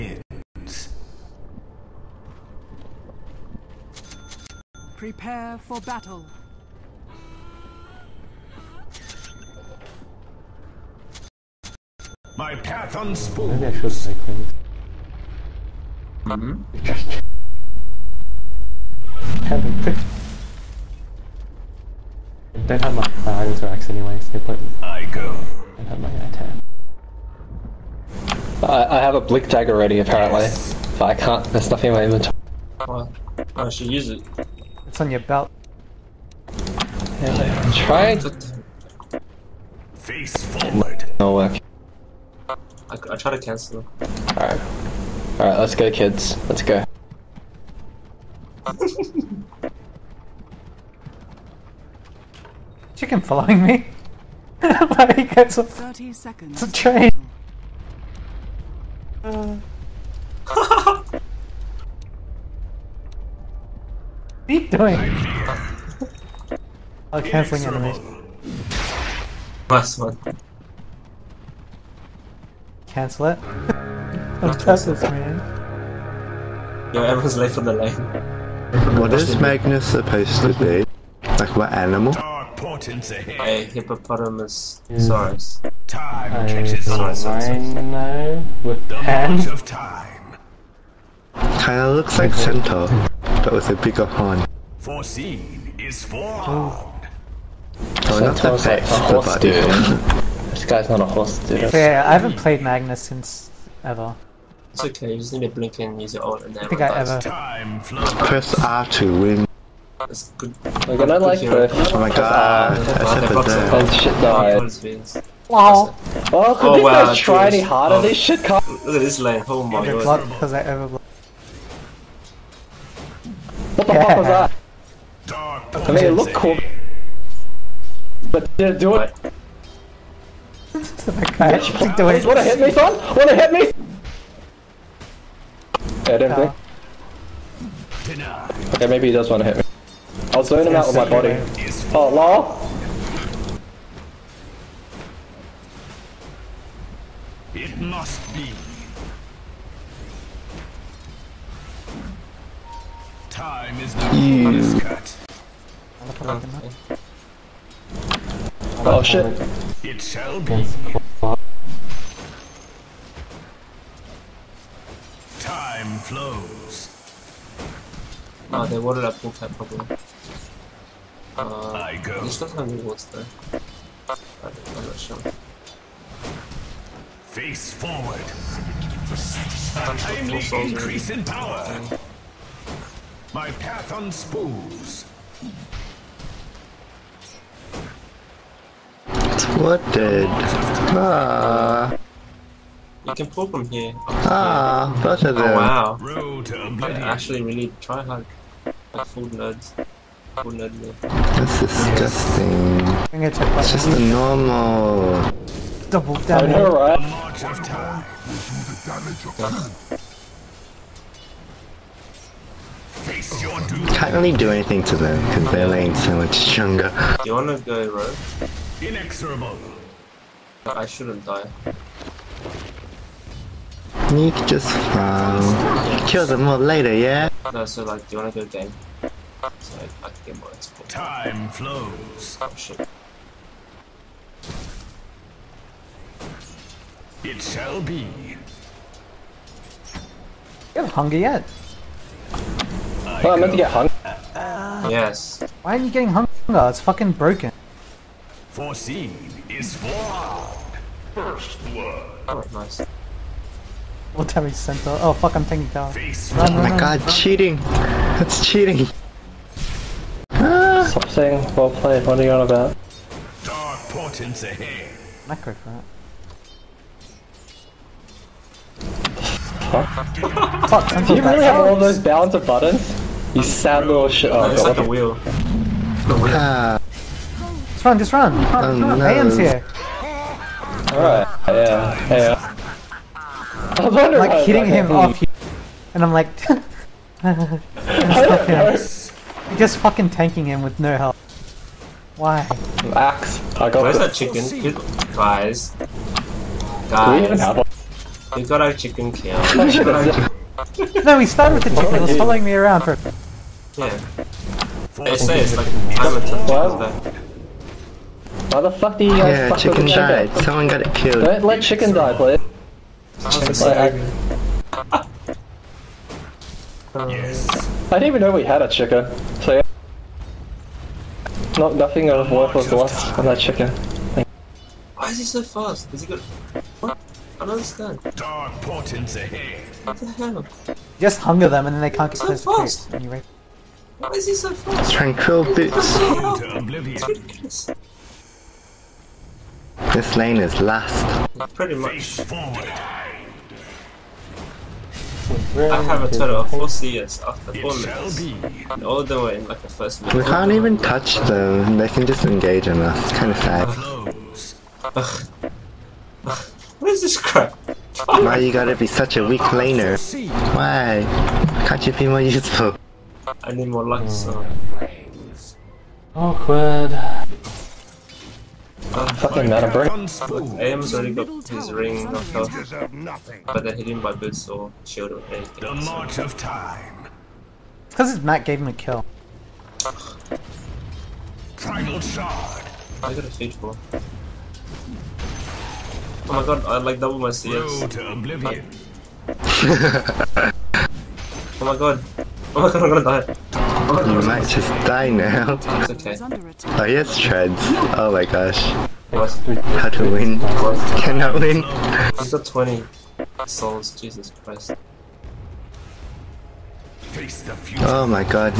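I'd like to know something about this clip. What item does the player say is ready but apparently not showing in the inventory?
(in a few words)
blink dagger.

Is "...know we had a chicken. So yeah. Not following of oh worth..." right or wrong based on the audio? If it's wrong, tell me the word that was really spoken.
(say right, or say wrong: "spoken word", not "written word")
wrong: "nothing", not "following".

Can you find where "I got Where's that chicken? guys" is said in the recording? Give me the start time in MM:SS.
04:53.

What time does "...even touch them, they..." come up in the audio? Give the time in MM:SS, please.
05:50.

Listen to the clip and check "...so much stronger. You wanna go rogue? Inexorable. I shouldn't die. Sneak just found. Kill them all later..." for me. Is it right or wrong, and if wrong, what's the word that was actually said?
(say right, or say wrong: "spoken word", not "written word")
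right.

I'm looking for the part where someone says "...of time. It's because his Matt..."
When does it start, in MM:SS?
06:16.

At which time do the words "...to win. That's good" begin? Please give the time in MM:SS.
01:48.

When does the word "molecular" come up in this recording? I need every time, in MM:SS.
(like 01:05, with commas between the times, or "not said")
not said.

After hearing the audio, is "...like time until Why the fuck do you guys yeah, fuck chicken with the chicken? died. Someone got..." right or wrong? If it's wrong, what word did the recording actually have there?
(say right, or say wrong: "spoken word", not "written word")
right.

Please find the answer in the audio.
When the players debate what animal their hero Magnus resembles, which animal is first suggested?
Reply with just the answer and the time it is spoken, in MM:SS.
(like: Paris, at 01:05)
hippopotamus, at 01:22.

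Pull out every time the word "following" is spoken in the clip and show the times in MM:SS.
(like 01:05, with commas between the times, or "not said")
00:53, 05:02.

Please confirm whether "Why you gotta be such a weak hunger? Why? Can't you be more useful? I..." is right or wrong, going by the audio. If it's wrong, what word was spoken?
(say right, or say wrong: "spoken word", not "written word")
wrong: "laner", not "hunger".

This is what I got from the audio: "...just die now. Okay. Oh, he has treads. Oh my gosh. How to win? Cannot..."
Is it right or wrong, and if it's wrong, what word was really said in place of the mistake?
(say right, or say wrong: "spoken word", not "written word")
right.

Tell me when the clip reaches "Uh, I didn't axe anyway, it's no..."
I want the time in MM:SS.
00:23.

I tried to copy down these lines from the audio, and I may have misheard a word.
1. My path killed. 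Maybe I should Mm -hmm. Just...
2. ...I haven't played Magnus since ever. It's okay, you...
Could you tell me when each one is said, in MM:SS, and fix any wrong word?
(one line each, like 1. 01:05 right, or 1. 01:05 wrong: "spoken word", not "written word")
1. 00:12 wrong: "unspooled", not "killed"
2. 01:42 right.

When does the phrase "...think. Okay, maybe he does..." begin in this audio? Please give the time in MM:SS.
02:18.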